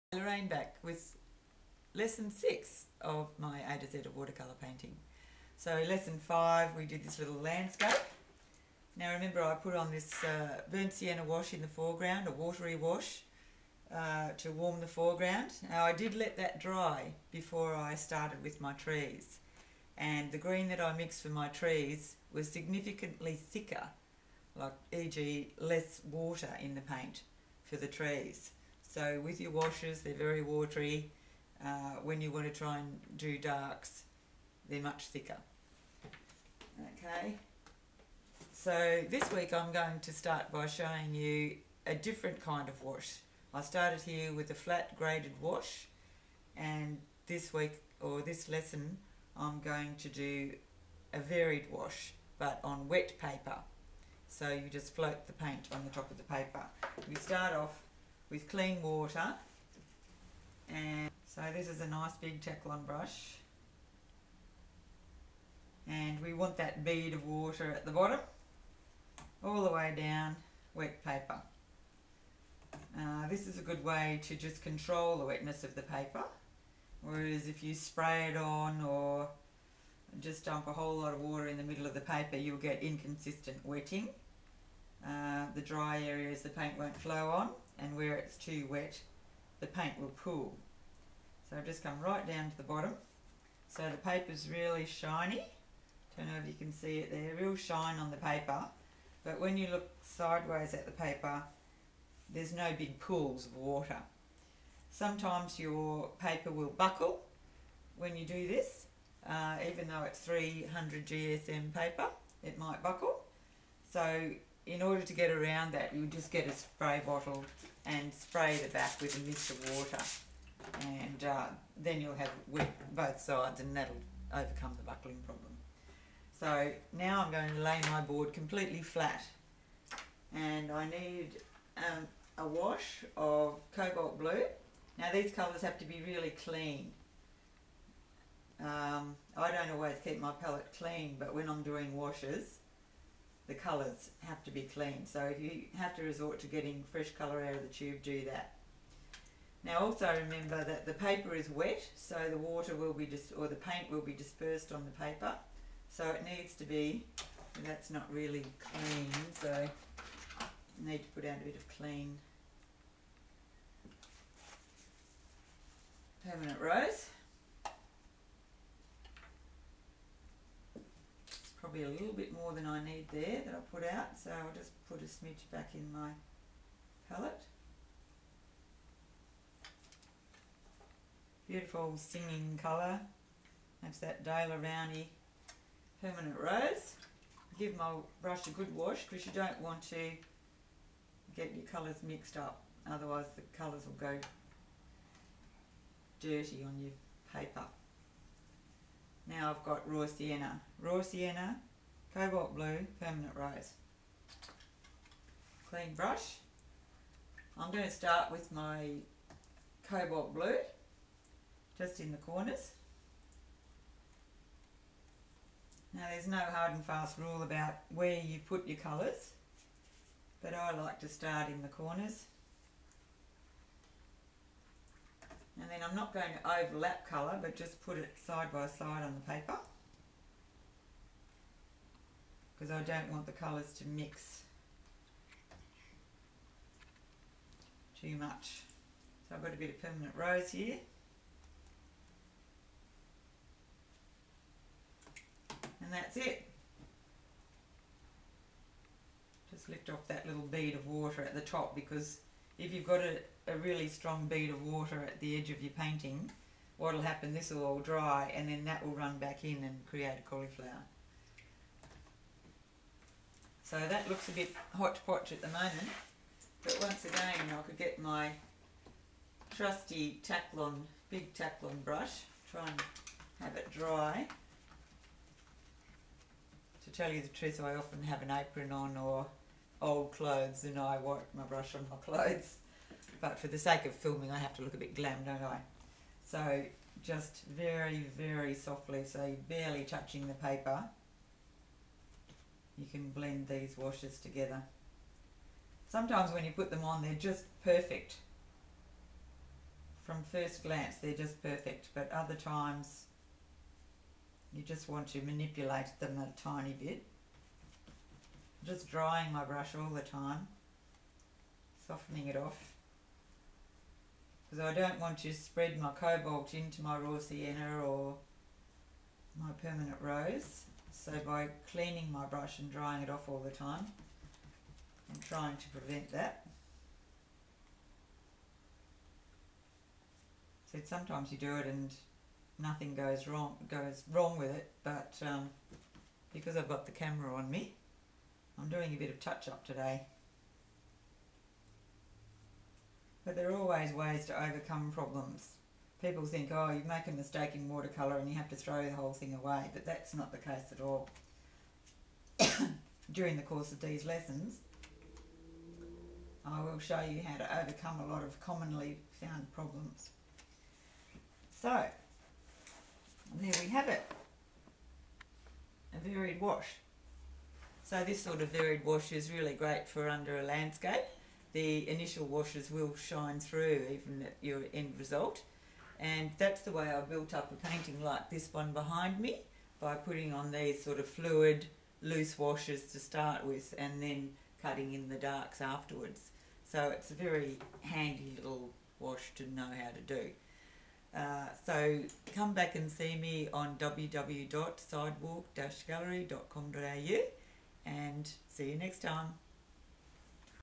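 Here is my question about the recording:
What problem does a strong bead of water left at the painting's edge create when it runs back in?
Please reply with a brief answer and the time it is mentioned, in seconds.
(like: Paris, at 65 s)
A cauliflower, at 260 s.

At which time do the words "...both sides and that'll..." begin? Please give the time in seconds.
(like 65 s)
122 s.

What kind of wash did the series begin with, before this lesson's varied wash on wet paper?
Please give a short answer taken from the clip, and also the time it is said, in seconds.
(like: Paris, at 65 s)
Flat graded wash, at 44 s.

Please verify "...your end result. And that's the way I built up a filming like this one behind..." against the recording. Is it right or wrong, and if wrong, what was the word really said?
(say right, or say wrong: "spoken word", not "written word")
wrong: "painting", not "filming".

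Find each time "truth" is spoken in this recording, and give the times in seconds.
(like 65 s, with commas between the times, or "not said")
277 s.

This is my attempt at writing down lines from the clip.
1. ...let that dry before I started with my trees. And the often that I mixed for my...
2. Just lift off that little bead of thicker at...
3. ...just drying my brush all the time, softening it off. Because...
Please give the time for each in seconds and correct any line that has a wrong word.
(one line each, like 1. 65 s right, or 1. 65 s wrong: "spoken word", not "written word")
1. 16 s wrong: "green", not "often"
2. 249 s wrong: "water", not "thicker"
3. 308 s right.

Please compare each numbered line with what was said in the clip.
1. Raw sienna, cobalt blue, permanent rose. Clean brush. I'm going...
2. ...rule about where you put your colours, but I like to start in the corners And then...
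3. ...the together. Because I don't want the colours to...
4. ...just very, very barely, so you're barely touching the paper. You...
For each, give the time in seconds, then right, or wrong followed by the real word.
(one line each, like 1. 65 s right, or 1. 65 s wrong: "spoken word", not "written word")
1. 200 s right
2. 217 s right
3. 229 s wrong: "paper", not "together"
4. 287 s wrong: "softly", not "barely".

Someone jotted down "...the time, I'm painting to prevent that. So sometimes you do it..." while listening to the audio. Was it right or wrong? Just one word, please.
wrong.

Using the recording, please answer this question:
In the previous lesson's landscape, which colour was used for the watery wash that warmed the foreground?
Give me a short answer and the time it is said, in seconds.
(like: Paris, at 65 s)
Burnt sienna, at 10 s.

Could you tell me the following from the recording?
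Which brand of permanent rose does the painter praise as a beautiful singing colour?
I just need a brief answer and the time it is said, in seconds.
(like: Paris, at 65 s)
Daler-Rowney, at 184 s.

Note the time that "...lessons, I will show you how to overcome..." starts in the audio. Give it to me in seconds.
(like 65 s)
354 s.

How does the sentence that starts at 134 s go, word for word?
Now these colours have to be really clean.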